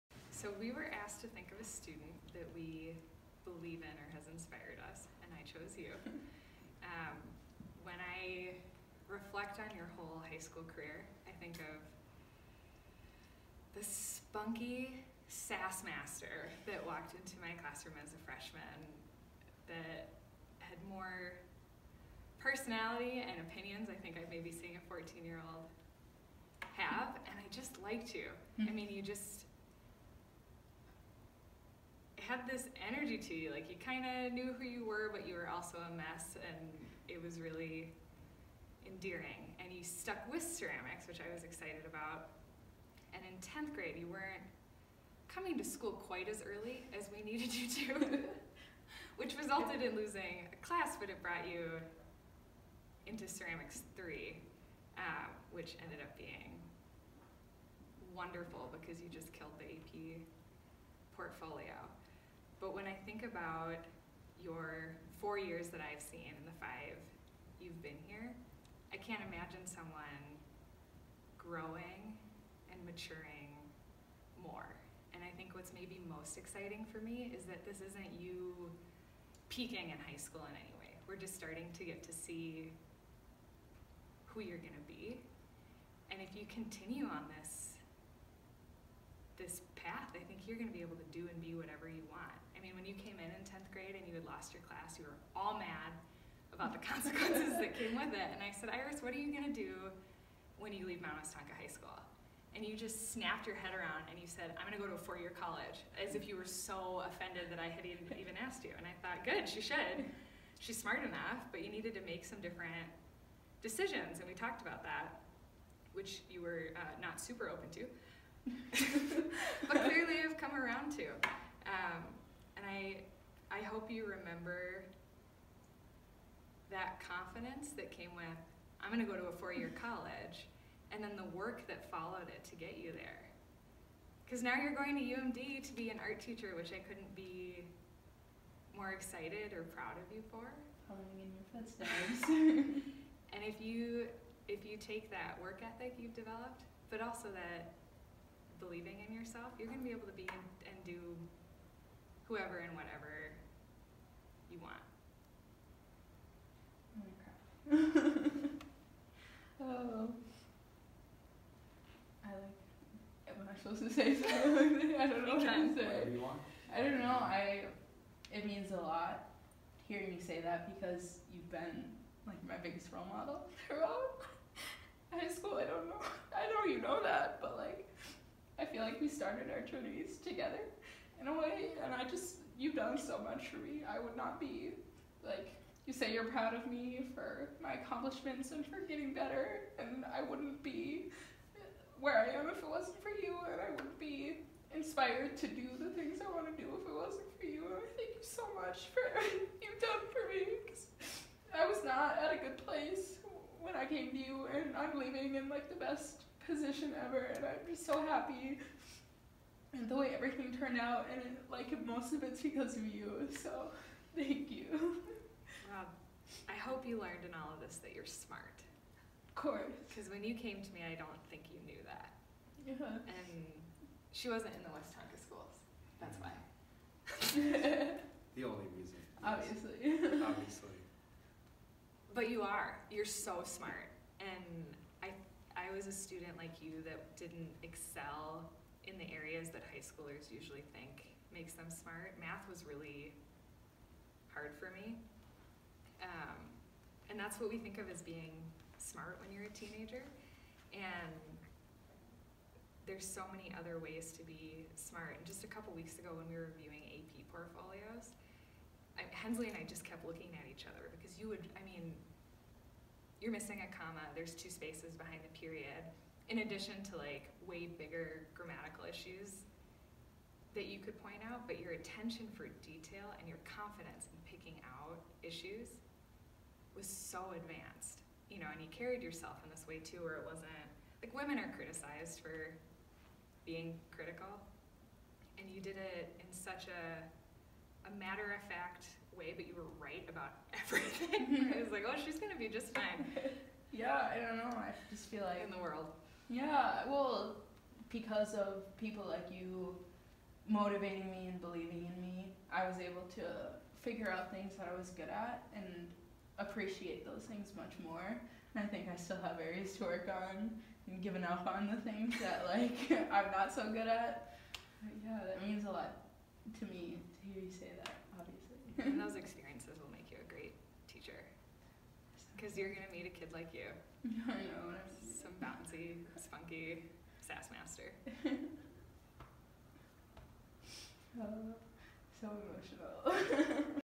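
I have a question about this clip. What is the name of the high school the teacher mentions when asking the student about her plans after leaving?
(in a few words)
Mound Westonka High School.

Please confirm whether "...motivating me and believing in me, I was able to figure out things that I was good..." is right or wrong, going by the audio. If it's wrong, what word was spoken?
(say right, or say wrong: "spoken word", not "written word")
right.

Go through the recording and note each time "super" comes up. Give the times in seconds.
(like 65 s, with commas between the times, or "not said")
117 s.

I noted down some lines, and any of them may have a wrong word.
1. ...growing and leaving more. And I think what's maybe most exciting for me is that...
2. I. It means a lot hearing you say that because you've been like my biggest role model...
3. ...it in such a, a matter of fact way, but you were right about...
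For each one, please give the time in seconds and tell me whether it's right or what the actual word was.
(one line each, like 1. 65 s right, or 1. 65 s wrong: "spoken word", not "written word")
1. 71 s wrong: "maturing", not "leaving"
2. 167 s right
3. 285 s right.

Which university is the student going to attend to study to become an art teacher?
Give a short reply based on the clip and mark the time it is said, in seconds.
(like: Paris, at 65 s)
UMD, at 135 s.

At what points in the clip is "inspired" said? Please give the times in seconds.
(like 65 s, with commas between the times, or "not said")
4 s, 194 s.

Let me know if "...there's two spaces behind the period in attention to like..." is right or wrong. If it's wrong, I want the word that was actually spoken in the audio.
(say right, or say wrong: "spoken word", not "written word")
wrong: "addition", not "attention".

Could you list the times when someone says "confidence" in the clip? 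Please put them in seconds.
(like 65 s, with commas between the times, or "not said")
127 s, 273 s.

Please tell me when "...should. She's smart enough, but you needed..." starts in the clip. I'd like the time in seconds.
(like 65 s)
109 s.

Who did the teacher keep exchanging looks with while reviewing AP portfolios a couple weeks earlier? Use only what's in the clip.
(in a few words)
Hensley.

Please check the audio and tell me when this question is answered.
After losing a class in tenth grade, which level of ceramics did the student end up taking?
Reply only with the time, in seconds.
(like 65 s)
53 s.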